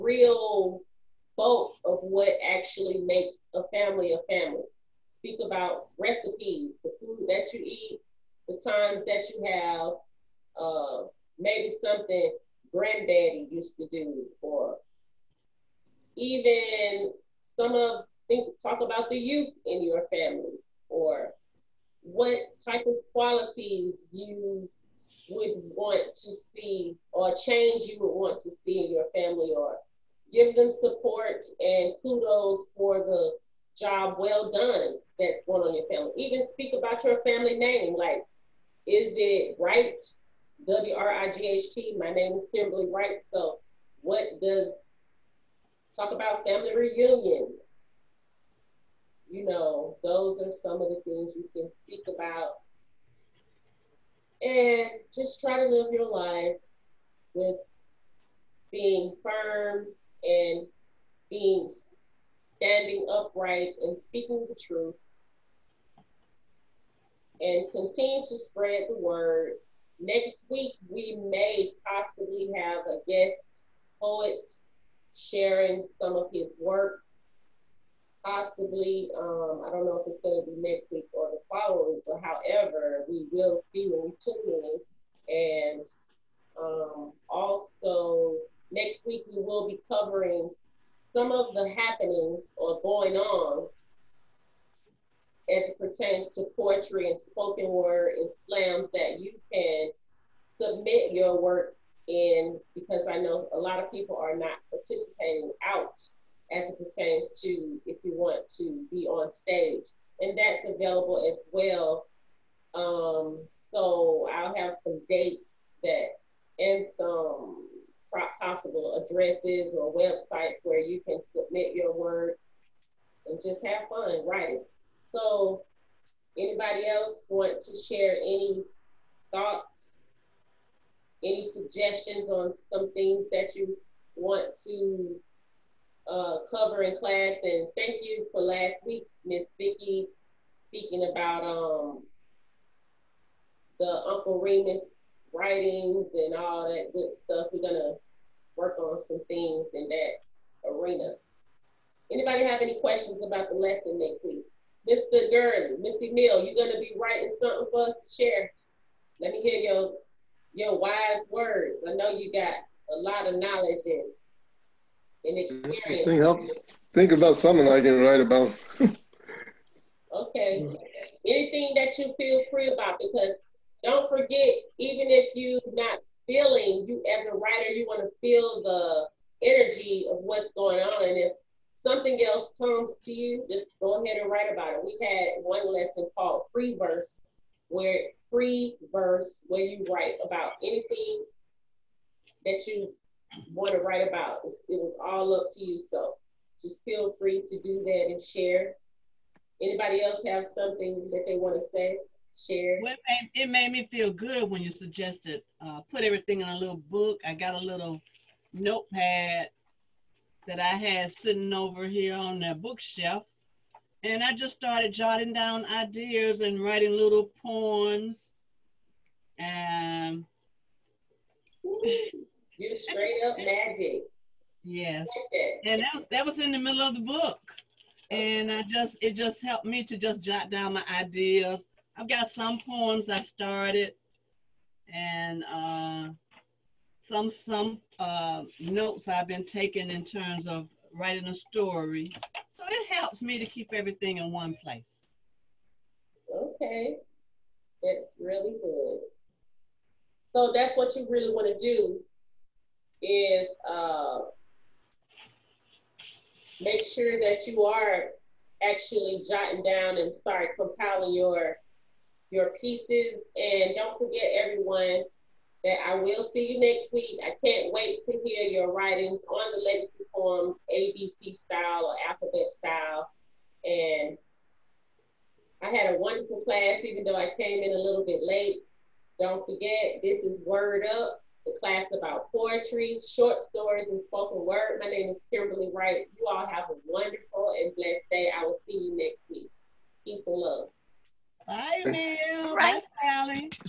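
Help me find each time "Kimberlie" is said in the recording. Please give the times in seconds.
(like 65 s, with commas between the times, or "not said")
42 s, 285 s.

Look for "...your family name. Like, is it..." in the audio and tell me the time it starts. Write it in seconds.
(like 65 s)
37 s.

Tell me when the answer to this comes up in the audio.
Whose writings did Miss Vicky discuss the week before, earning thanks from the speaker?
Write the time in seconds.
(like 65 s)
143 s.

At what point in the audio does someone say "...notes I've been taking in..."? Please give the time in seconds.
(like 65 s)
238 s.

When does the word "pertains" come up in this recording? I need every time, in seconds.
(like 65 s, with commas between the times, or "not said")
95 s, 106 s.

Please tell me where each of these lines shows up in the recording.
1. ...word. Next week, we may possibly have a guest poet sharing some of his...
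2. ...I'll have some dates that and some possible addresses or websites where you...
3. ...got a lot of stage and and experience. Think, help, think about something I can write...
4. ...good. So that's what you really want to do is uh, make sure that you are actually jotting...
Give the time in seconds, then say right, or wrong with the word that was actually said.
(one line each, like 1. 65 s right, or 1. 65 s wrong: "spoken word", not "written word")
1. 68 s right
2. 114 s right
3. 162 s wrong: "knowledge", not "stage"
4. 248 s right.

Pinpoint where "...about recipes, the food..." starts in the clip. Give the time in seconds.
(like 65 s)
5 s.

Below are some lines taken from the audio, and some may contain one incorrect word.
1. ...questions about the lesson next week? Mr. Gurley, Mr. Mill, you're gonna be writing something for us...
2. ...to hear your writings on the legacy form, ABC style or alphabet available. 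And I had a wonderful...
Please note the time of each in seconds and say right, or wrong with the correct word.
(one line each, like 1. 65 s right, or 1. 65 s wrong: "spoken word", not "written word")
1. 152 s right
2. 268 s wrong: "style", not "available".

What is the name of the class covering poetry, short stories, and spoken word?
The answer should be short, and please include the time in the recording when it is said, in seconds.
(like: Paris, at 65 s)
Word Up, at 280 s.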